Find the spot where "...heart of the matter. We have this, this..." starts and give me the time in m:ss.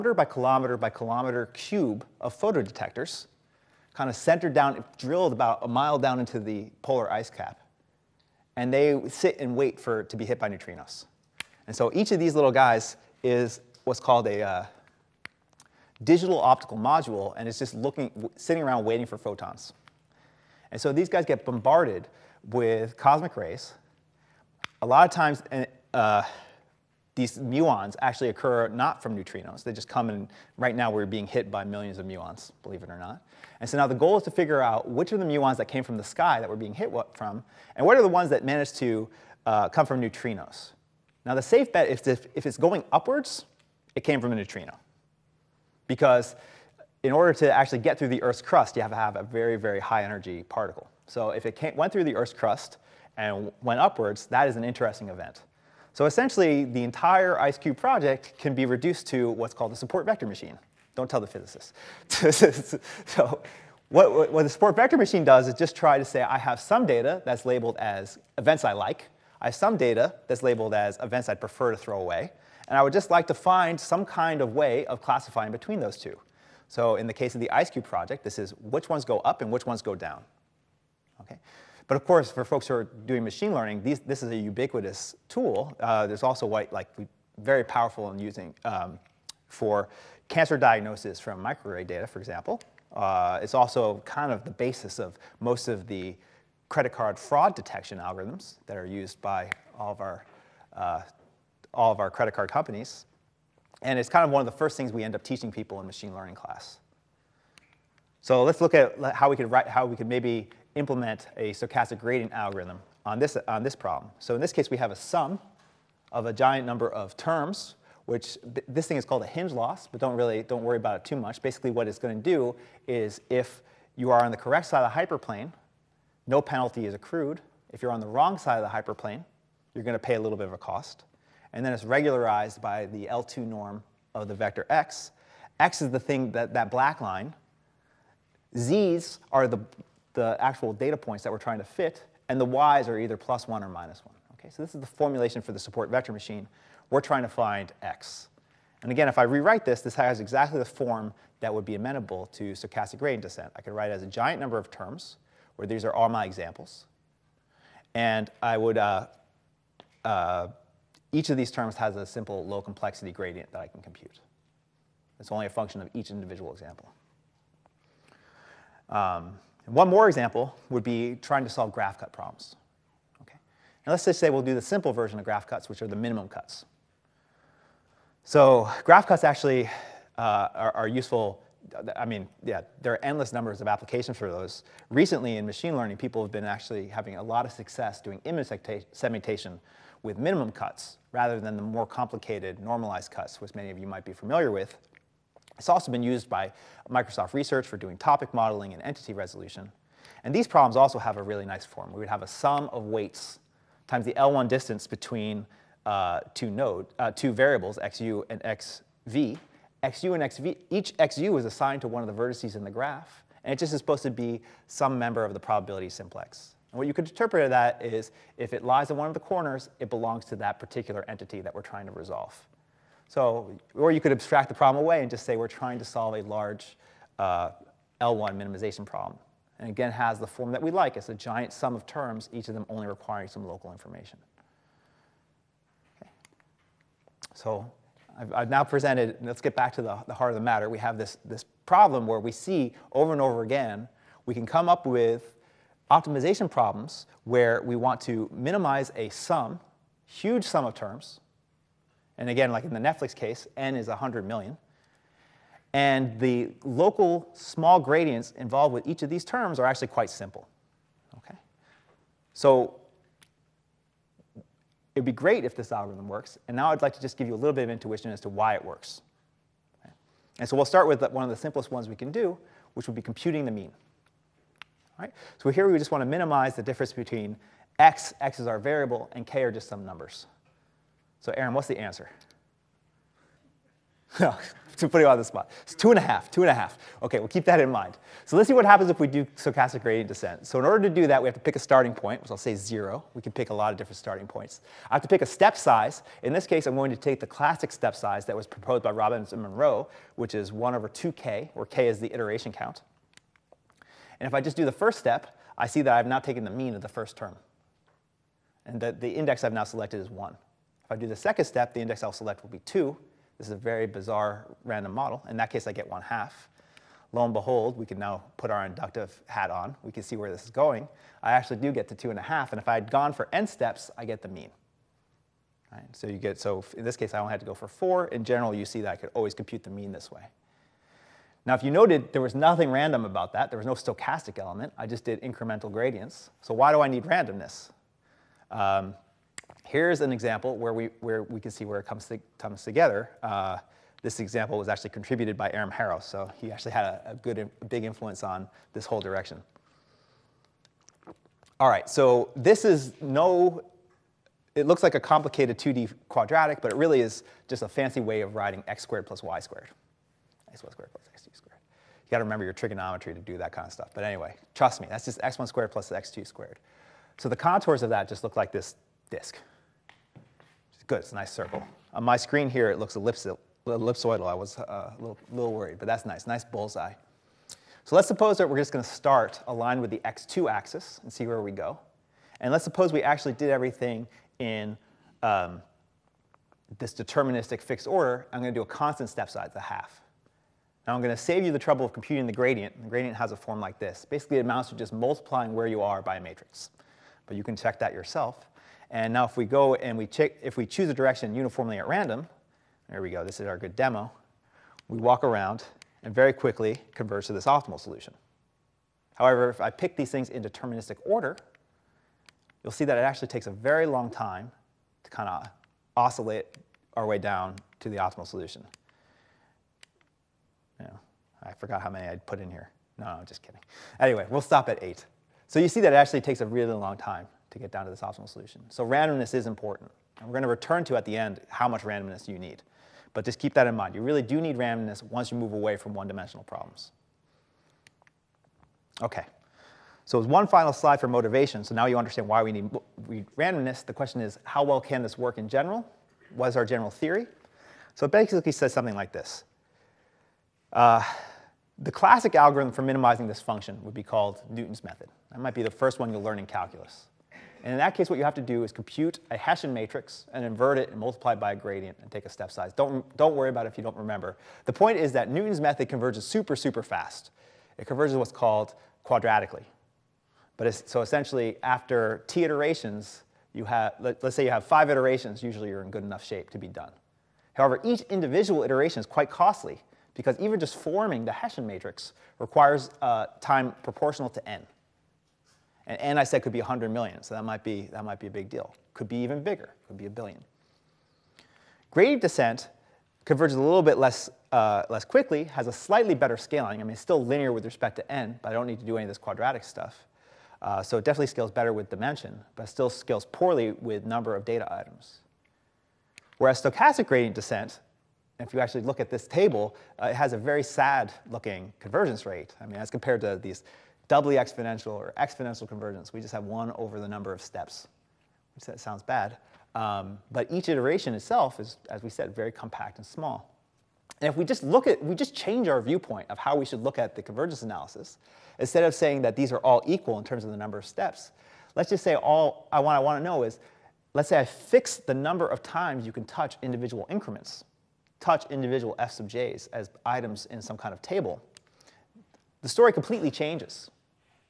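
4:00.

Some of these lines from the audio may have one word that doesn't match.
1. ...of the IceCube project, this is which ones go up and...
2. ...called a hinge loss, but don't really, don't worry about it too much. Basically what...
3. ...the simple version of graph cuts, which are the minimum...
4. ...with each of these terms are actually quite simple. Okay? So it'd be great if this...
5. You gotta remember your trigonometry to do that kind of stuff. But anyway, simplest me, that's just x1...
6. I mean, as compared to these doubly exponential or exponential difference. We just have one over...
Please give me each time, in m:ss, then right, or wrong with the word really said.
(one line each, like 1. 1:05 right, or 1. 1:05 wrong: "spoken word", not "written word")
1. 1:17 right
2. 1:59 right
3. 2:54 right
4. 4:18 right
5. 6:01 wrong: "trust", not "simplest"
6. 8:32 wrong: "convergence", not "difference".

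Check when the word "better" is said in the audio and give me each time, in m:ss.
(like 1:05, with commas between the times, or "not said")
8:16, 8:21.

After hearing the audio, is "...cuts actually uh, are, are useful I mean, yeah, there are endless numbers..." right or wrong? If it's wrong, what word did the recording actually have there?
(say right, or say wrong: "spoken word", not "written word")
right.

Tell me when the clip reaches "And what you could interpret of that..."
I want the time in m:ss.
3:36.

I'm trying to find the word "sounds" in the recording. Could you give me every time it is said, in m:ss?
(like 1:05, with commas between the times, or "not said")
8:38.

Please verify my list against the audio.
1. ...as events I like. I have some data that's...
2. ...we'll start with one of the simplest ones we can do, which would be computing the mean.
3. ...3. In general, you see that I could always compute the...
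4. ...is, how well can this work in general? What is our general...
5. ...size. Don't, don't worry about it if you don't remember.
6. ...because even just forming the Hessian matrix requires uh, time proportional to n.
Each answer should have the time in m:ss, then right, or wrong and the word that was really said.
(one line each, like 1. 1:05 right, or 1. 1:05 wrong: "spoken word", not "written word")
1. 1:07 right
2. 4:30 right
3. 5:27 wrong: "4", not "3"
4. 7:24 right
5. 7:42 right
6. 8:00 right.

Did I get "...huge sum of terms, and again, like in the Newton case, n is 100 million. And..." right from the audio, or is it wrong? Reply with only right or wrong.
wrong.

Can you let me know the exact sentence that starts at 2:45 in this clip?
It's only a function of each individual example.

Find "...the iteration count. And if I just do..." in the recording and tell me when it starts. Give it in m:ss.
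5:01.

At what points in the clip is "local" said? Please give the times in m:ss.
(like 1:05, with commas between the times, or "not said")
3:53, 4:16.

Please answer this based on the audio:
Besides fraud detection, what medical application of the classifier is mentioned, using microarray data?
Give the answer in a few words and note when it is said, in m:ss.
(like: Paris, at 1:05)
cancer diagnosis, at 1:30.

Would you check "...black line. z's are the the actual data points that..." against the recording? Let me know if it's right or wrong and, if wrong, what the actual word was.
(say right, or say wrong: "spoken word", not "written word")
right.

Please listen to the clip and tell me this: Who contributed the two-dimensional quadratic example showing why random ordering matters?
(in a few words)
Aram Harrow.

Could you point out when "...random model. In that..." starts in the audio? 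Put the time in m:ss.
5:14.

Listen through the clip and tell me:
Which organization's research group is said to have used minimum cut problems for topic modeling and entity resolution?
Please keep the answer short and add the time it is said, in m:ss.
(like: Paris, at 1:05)
Microsoft Research, at 3:16.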